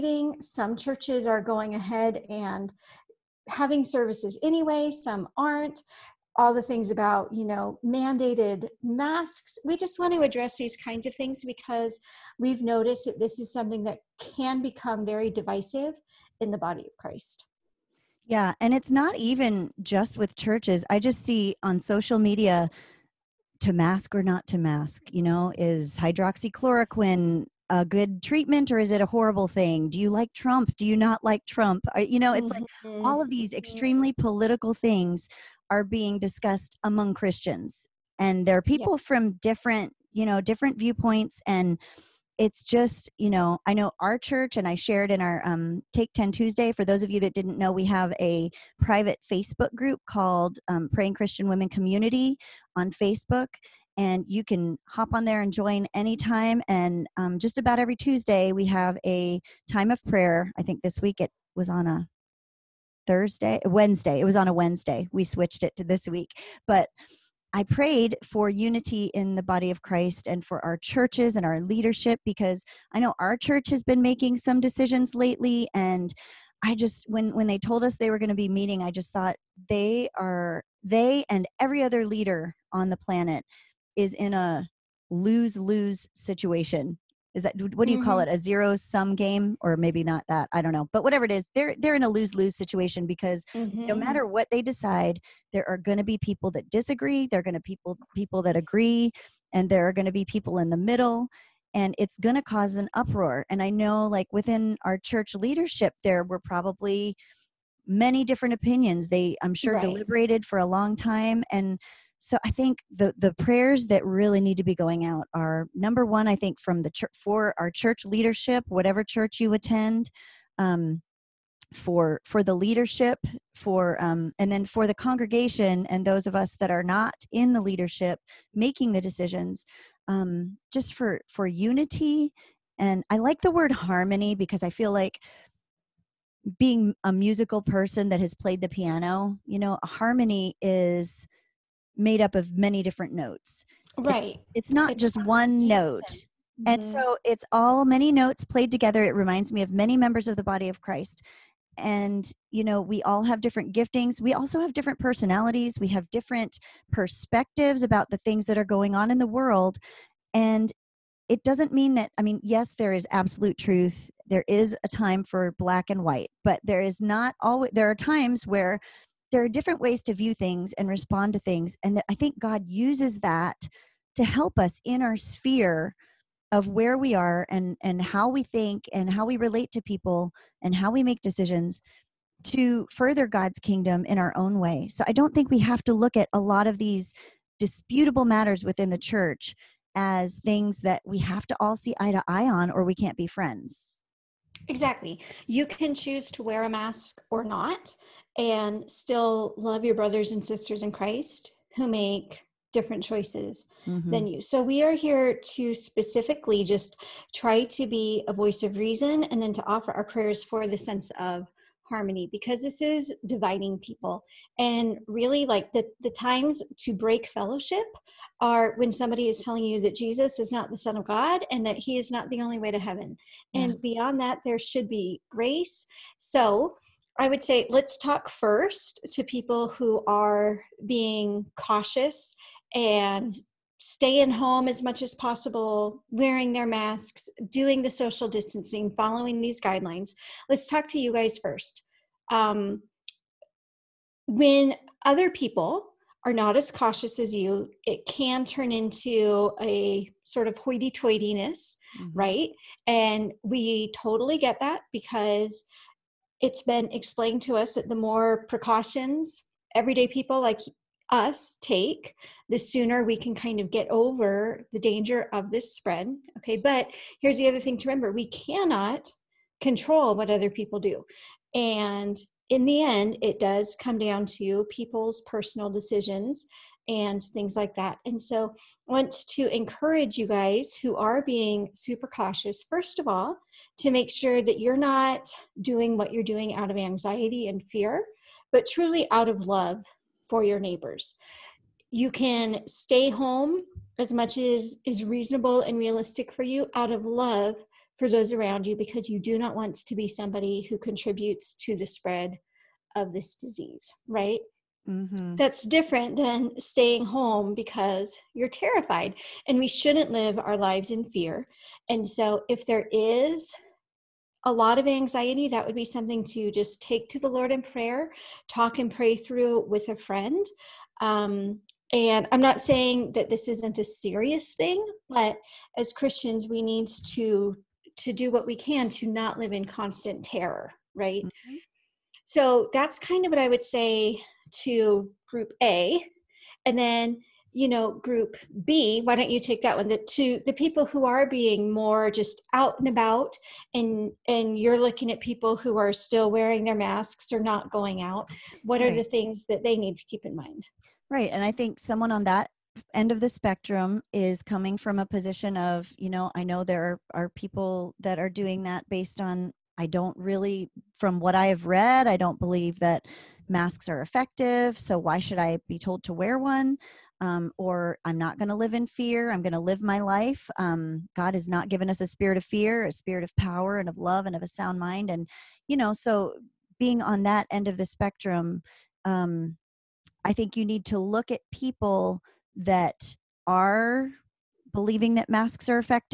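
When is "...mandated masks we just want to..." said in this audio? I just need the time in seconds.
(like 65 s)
7 s.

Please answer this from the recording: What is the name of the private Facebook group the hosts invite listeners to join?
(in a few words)
Praying Christian Women Community.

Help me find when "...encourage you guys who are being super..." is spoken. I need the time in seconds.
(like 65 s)
279 s.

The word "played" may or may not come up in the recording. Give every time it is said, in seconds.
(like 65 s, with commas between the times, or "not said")
138 s, 148 s.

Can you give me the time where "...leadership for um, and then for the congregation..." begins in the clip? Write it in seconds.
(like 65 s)
122 s.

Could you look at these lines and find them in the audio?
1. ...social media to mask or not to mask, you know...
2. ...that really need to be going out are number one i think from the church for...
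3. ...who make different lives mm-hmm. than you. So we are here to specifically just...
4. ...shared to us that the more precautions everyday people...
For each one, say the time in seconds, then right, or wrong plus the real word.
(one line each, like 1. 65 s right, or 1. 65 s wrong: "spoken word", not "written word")
1. 21 s right
2. 113 s right
3. 201 s wrong: "choices", not "lives"
4. 256 s wrong: "explained", not "shared".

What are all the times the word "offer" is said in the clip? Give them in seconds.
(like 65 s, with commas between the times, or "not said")
209 s.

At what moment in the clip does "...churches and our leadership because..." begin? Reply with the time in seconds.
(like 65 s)
70 s.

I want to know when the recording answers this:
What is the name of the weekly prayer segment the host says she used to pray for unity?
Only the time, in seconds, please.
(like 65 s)
45 s.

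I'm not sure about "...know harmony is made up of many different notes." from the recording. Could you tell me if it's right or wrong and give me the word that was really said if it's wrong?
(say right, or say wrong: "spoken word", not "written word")
right.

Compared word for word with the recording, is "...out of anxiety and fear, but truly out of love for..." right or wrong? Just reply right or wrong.
right.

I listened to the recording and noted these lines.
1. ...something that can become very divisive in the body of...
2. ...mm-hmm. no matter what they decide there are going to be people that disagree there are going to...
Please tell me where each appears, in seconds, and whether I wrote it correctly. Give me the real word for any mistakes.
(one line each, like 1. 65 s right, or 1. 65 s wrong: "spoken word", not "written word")
1. 13 s right
2. 93 s right.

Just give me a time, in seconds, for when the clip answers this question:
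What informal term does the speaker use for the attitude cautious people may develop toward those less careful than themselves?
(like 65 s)
250 s.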